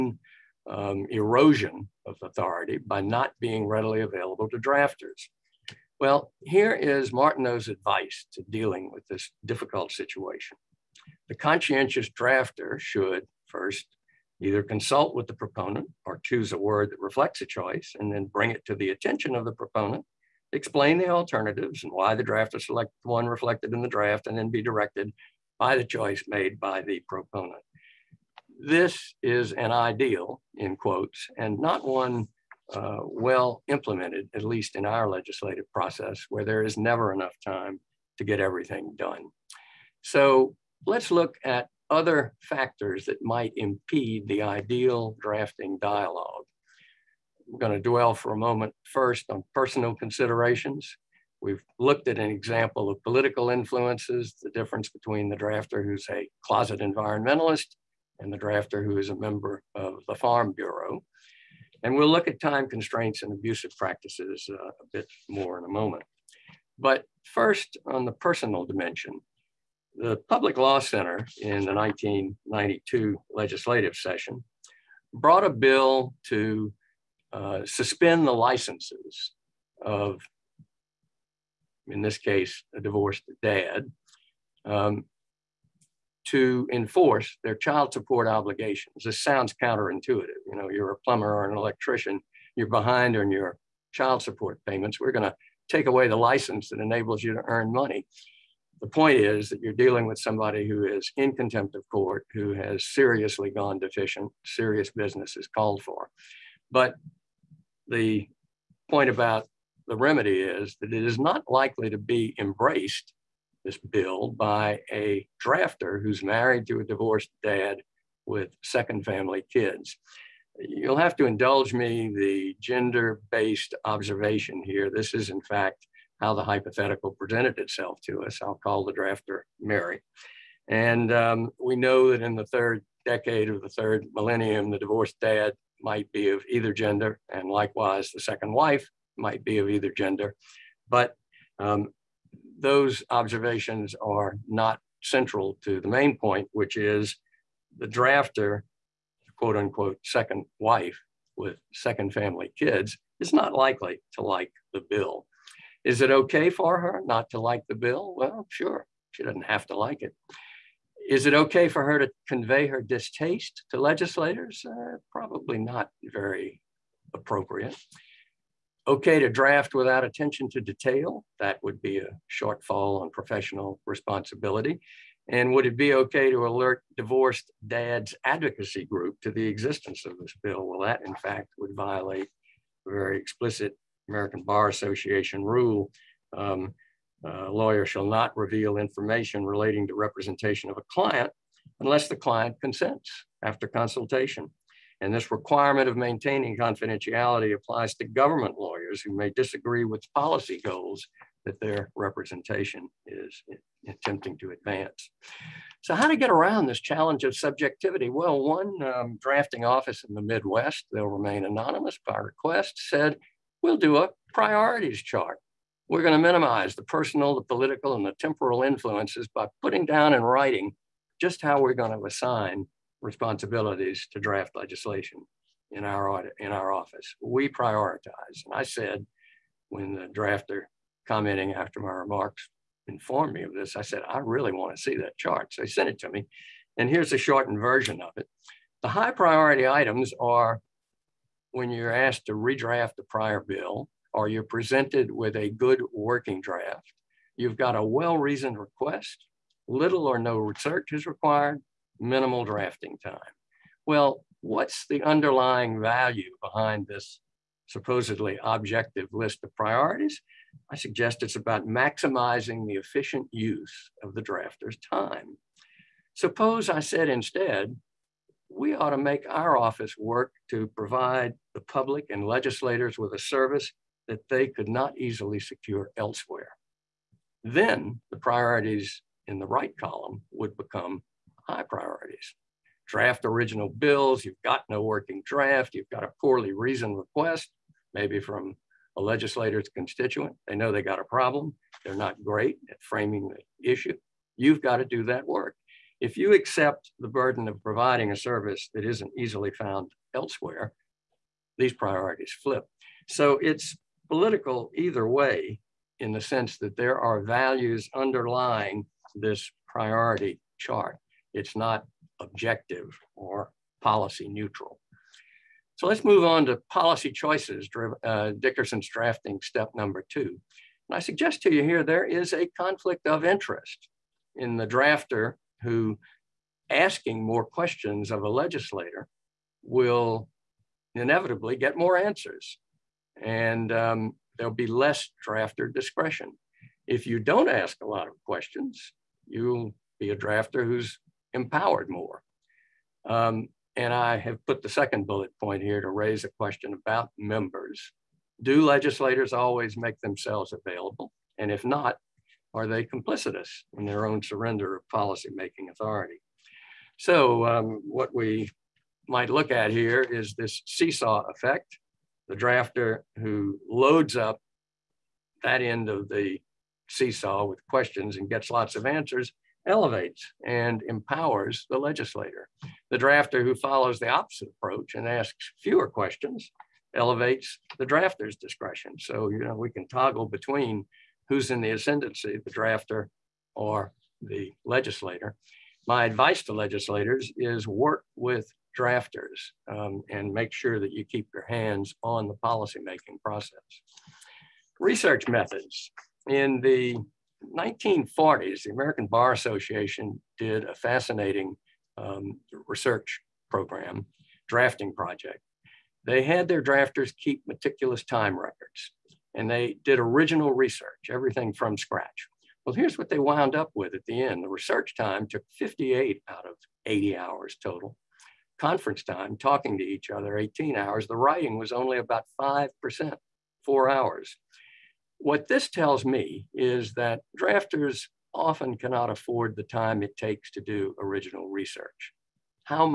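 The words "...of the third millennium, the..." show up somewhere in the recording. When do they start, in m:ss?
2:13.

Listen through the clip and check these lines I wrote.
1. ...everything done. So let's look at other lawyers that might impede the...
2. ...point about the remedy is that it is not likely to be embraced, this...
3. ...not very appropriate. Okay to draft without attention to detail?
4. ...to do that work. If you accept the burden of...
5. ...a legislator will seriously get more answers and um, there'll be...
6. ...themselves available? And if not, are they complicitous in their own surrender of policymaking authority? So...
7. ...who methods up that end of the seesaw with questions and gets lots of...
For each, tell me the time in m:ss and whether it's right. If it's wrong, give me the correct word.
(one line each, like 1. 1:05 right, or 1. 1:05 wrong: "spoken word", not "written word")
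1. 0:38 wrong: "factors", not "lawyers"
2. 1:48 right
3. 2:45 right
4. 4:54 right
5. 5:28 wrong: "inevitably", not "seriously"
6. 5:50 right
7. 6:03 wrong: "loads", not "methods".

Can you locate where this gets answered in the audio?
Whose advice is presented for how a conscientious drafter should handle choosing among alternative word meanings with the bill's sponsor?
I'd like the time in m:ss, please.
0:07.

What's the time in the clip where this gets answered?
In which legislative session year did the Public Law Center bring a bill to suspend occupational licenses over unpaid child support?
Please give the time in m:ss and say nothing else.
1:11.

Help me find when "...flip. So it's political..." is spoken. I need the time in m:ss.
5:02.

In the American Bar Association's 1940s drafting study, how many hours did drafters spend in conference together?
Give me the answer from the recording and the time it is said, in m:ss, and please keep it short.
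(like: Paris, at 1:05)
18 hours, at 7:00.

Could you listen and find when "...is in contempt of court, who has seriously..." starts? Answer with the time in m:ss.
1:40.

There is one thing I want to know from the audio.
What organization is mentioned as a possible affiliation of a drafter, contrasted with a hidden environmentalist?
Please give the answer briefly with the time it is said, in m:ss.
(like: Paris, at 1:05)
Farm Bureau, at 1:00.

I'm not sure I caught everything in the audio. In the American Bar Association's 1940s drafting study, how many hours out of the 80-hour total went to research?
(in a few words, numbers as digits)
58.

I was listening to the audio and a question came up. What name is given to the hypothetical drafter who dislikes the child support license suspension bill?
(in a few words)
Mary.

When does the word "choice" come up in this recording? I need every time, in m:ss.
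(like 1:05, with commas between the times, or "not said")
0:17, 0:25, 5:17.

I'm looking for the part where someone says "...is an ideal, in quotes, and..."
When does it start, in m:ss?
0:29.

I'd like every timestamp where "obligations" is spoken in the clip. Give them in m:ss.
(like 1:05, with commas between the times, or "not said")
1:28.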